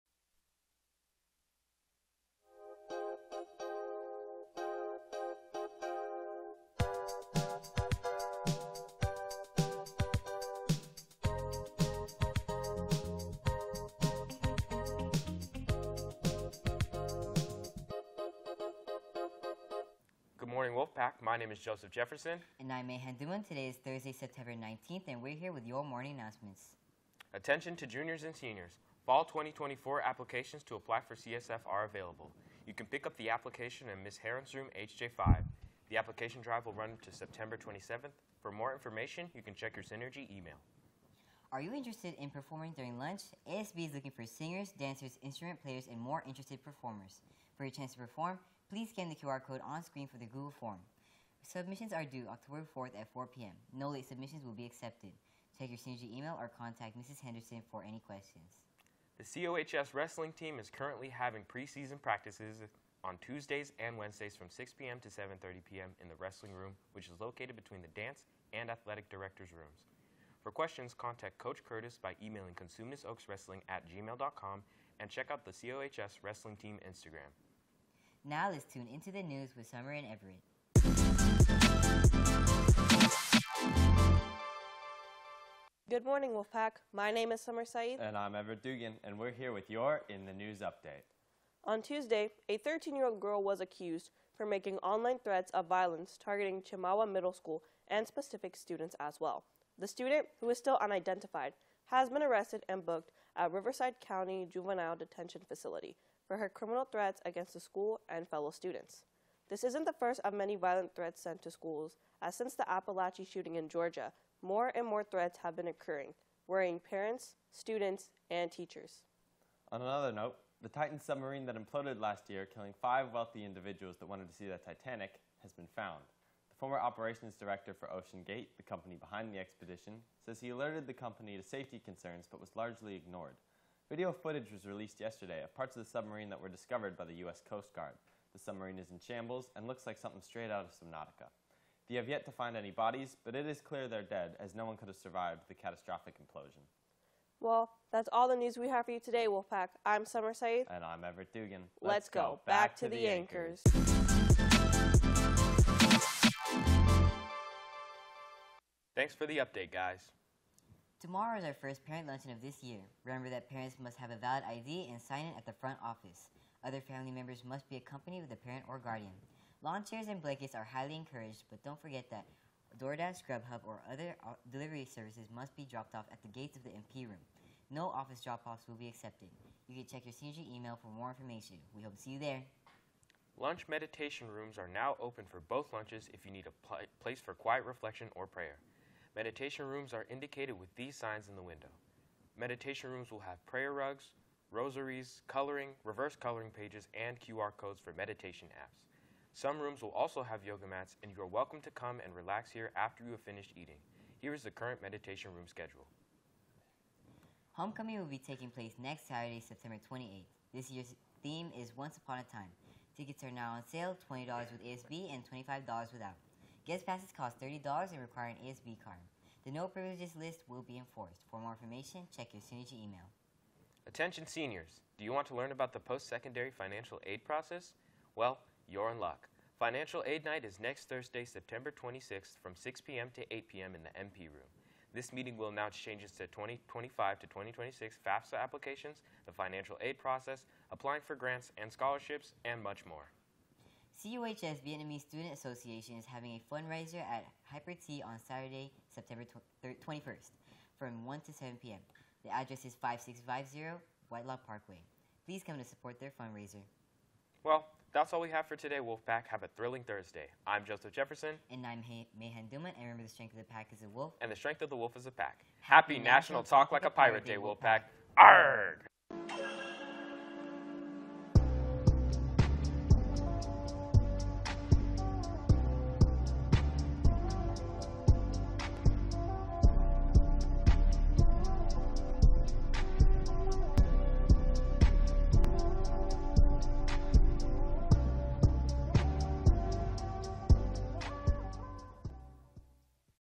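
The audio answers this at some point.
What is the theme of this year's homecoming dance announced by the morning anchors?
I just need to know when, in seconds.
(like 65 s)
211 s.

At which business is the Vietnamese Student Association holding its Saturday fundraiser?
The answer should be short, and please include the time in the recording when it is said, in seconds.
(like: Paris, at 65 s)
Hyper T, at 247 s.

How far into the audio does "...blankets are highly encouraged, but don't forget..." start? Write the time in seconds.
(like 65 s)
170 s.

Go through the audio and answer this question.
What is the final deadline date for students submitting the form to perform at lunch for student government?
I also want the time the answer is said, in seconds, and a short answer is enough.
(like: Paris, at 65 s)
October 4th, at 52 s.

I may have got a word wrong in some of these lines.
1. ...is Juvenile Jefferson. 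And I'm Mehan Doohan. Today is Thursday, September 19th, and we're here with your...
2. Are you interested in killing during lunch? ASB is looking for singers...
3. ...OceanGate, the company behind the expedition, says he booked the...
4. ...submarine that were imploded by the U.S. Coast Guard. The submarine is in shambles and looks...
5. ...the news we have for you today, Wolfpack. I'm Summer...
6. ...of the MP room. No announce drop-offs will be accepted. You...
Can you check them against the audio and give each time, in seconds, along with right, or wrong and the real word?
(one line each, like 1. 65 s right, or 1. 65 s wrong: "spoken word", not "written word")
1. 21 s wrong: "Joseph", not "Juvenile"
2. 41 s wrong: "performing", not "killing"
3. 127 s wrong: "alerted", not "booked"
4. 135 s wrong: "discovered", not "imploded"
5. 148 s right
6. 176 s wrong: "office", not "announce".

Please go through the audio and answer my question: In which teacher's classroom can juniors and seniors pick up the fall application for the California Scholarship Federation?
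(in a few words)
Ms. Heron's room.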